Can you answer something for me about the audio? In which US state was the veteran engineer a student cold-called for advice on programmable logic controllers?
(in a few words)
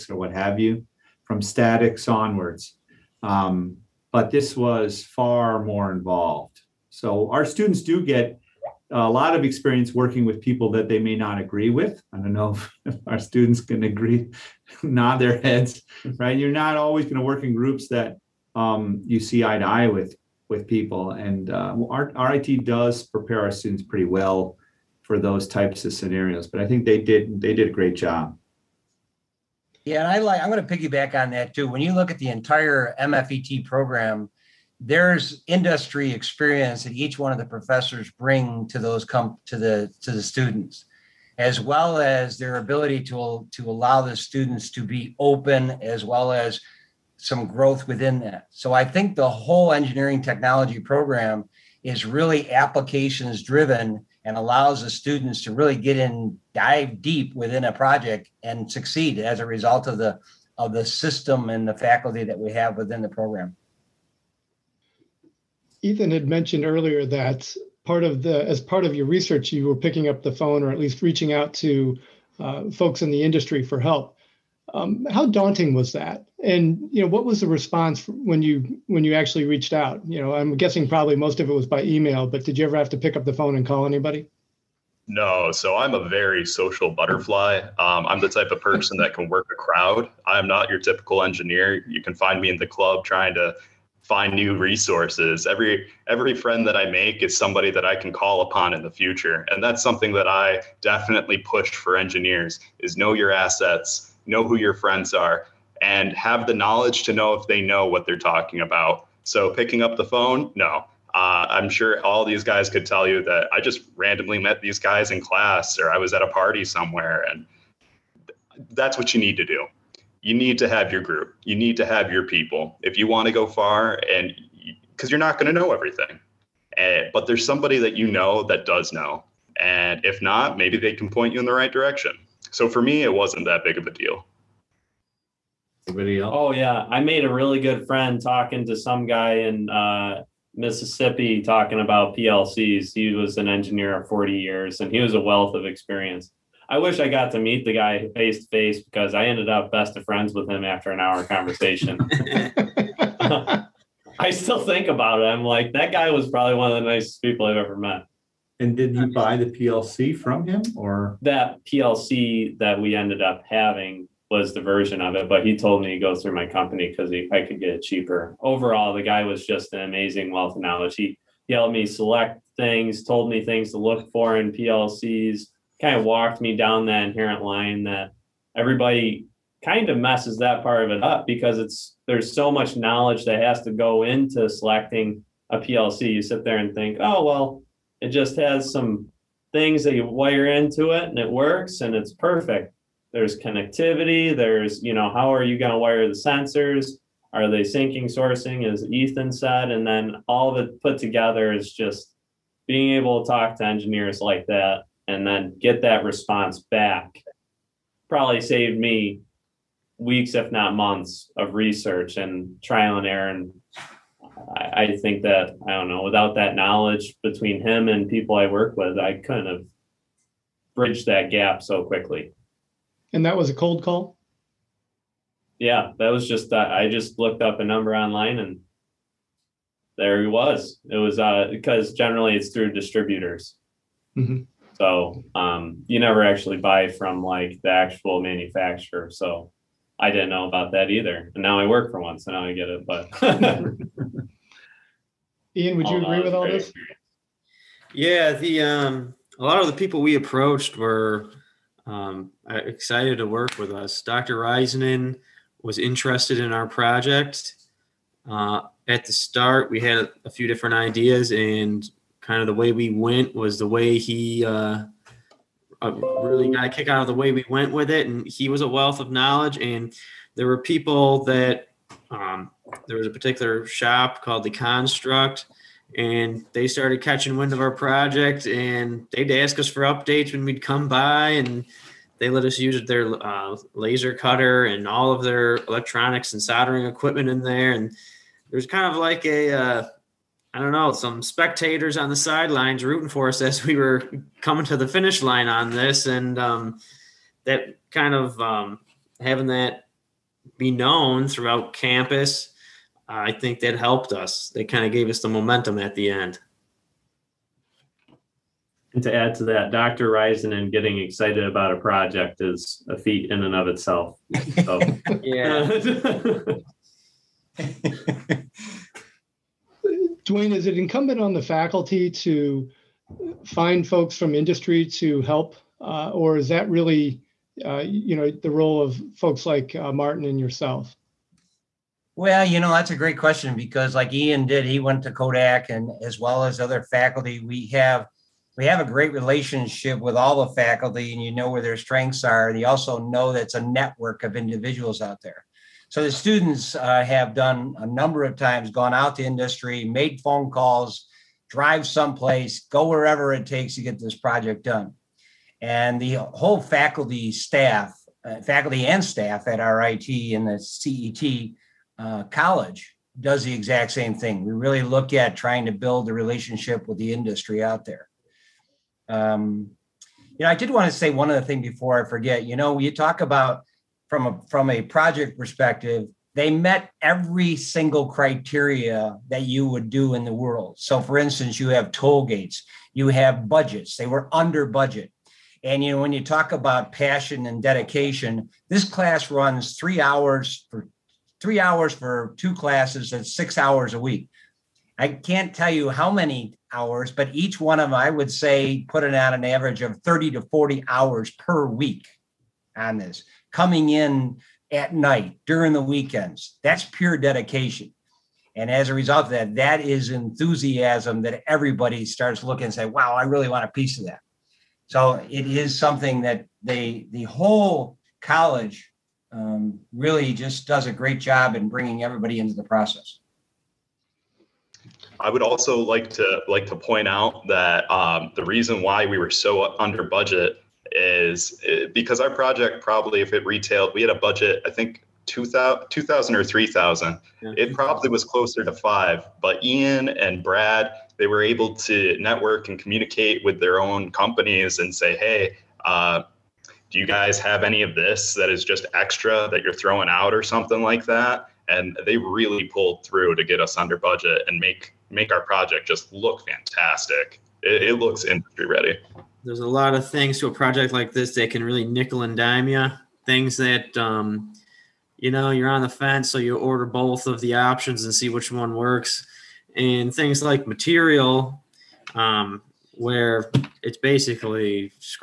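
Mississippi.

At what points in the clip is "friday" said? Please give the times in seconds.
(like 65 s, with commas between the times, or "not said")
not said.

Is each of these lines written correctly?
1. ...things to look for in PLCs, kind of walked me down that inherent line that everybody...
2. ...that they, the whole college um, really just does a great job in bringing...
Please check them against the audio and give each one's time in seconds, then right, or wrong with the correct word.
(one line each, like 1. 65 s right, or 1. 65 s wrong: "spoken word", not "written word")
1. 173 s right
2. 416 s right.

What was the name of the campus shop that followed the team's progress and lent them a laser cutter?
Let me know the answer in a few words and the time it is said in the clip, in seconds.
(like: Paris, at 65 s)
the Construct, at 274 s.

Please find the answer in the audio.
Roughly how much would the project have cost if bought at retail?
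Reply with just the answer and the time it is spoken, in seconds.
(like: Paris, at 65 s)
5000, at 438 s.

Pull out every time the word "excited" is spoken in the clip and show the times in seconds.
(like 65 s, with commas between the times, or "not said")
252 s, 310 s.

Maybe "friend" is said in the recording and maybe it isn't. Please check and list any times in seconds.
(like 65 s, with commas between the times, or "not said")
96 s, 104 s, 137 s, 150 s.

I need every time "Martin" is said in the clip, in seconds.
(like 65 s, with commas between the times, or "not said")
329 s.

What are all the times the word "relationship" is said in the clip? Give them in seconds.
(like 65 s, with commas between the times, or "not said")
339 s, 366 s.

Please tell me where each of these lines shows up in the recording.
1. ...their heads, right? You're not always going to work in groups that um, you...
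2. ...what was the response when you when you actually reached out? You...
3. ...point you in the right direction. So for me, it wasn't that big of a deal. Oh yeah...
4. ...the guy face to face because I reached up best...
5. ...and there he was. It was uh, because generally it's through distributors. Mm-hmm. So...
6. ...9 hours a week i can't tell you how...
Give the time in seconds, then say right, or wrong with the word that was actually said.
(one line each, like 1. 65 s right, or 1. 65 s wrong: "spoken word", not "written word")
1. 15 s right
2. 77 s right
3. 131 s right
4. 147 s wrong: "ended", not "reached"
5. 228 s right
6. 393 s wrong: "6", not "9".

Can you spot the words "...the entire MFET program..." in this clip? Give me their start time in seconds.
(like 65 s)
32 s.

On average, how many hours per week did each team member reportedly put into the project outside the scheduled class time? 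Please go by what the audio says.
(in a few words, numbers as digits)
30 to 40.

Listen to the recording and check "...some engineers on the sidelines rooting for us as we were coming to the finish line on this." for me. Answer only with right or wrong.
wrong.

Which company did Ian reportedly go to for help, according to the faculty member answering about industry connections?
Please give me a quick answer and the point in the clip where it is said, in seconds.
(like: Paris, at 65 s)
Kodak, at 335 s.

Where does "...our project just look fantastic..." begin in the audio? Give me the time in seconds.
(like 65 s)
455 s.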